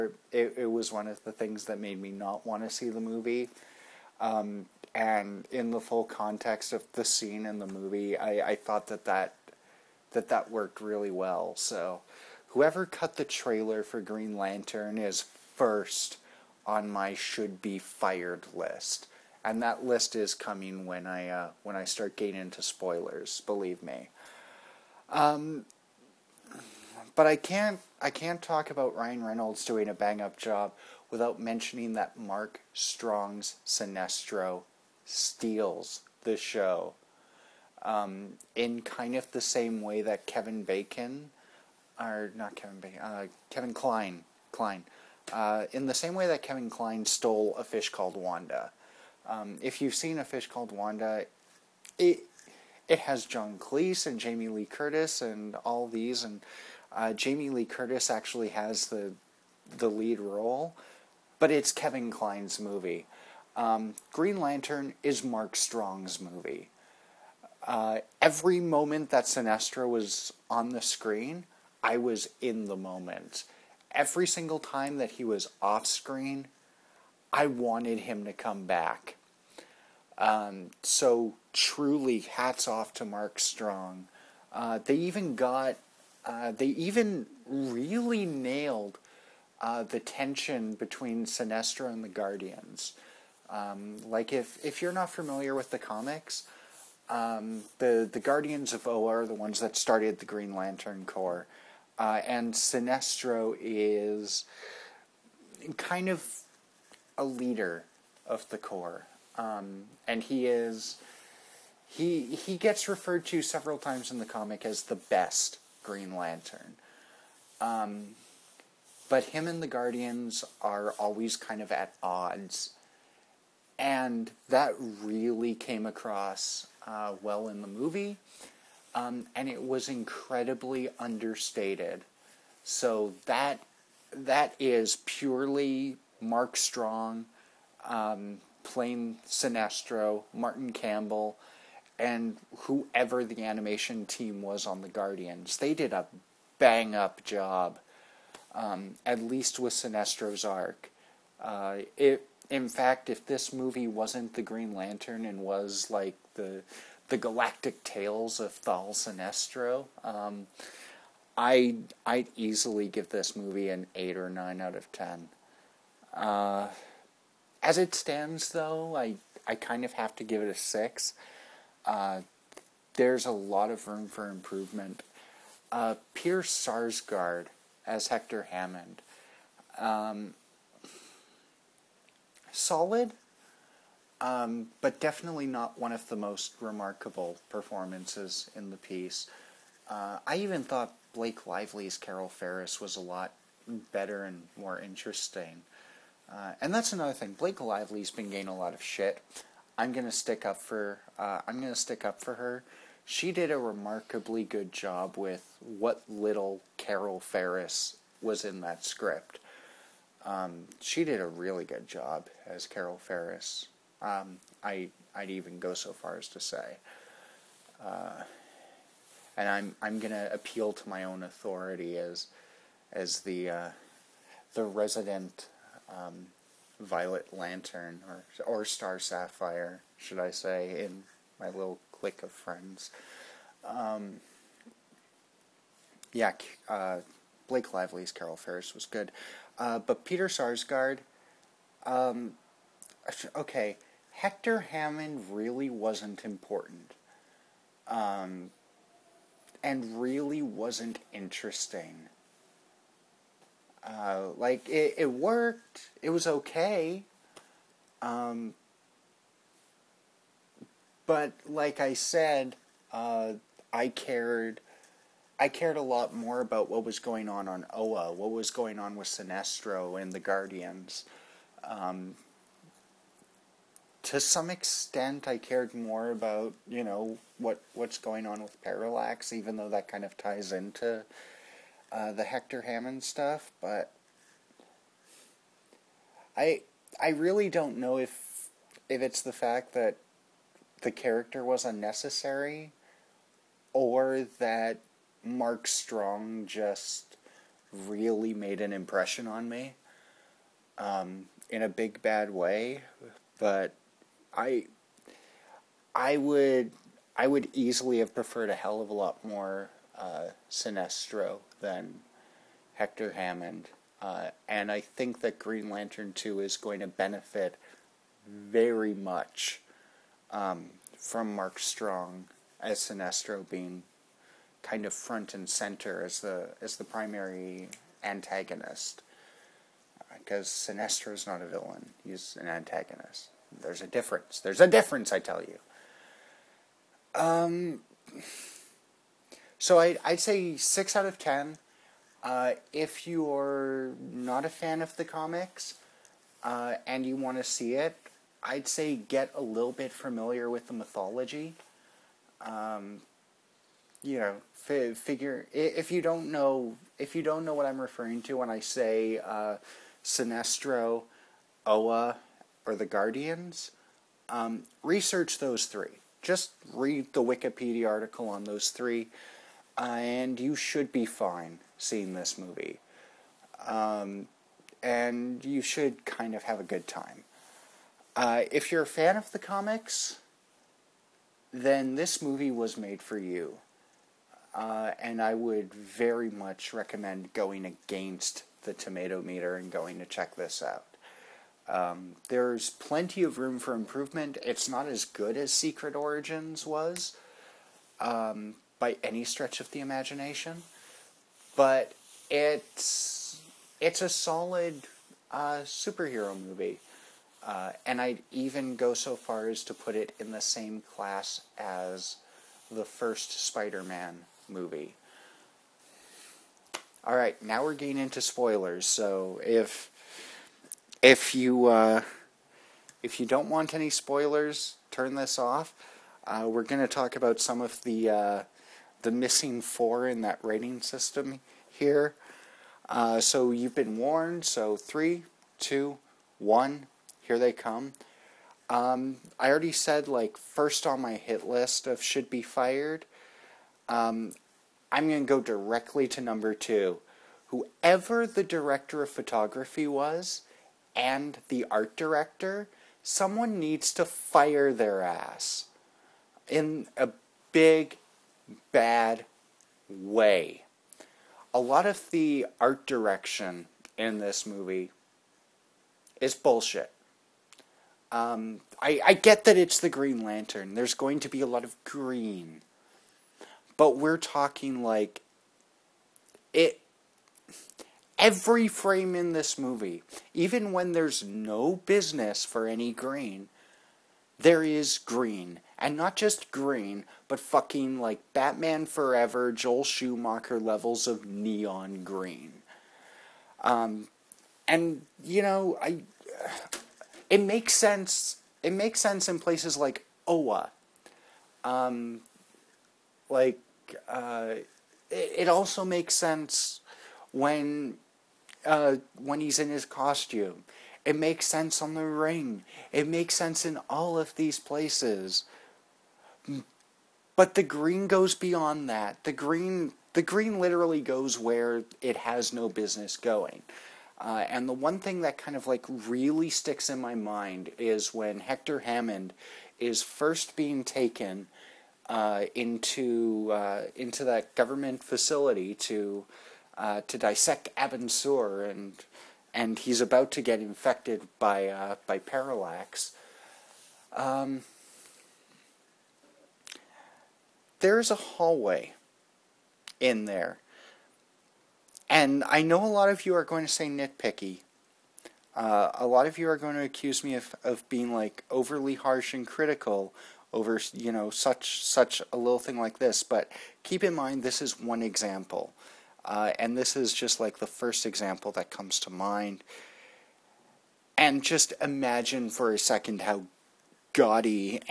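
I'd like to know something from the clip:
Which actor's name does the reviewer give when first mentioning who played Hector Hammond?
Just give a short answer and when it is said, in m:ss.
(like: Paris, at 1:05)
Pierce Sarsgaard, at 2:56.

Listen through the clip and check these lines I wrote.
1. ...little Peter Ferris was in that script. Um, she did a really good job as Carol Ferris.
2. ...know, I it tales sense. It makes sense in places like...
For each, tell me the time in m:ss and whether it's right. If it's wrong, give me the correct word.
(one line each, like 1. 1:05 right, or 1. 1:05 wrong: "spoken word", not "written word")
1. 3:26 wrong: "Carol", not "Peter"
2. 8:15 wrong: "makes", not "tales".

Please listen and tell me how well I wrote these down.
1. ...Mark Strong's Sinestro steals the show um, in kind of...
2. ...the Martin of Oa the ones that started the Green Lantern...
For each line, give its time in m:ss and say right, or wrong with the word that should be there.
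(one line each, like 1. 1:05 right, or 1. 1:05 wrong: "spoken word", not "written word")
1. 0:32 right
2. 1:38 wrong: "Guardians", not "Martin".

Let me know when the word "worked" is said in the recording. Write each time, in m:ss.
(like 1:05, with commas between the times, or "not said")
0:10, 4:15.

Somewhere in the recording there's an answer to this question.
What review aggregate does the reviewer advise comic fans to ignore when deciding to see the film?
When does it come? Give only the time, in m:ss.
6:28.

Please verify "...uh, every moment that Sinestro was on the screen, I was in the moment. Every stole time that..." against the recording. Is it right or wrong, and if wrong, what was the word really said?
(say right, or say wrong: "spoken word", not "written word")
wrong: "single", not "stole".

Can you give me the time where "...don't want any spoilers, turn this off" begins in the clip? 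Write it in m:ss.
7:03.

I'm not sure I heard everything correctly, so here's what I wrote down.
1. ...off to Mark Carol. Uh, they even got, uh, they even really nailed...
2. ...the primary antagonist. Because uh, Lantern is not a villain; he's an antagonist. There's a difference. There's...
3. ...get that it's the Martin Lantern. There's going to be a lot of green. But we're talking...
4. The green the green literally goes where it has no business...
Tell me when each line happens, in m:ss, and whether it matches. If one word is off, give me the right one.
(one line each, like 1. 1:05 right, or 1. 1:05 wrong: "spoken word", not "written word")
1. 1:22 wrong: "Strong", not "Carol"
2. 5:26 wrong: "Sinestro", not "Lantern"
3. 7:49 wrong: "Green", not "Martin"
4. 8:39 right.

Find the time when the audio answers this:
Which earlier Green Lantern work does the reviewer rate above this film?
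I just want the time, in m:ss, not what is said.
6:35.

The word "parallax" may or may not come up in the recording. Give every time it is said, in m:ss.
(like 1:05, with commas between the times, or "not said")
4:38, 9:02.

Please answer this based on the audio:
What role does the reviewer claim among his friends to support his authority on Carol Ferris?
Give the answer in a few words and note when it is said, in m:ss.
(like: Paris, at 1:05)
Star Sapphire, at 3:48.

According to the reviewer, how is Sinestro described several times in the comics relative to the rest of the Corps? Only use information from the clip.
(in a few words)
The best Green Lantern.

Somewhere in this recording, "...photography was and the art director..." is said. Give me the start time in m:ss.
7:29.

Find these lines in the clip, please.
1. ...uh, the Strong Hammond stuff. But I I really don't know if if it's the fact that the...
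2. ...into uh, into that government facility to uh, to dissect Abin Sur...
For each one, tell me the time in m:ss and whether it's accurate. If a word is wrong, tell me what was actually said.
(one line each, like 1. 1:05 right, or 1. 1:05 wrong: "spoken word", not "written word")
1. 4:41 wrong: "Hector", not "Strong"
2. 8:52 right.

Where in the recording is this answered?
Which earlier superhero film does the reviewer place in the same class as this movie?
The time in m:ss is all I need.
6:52.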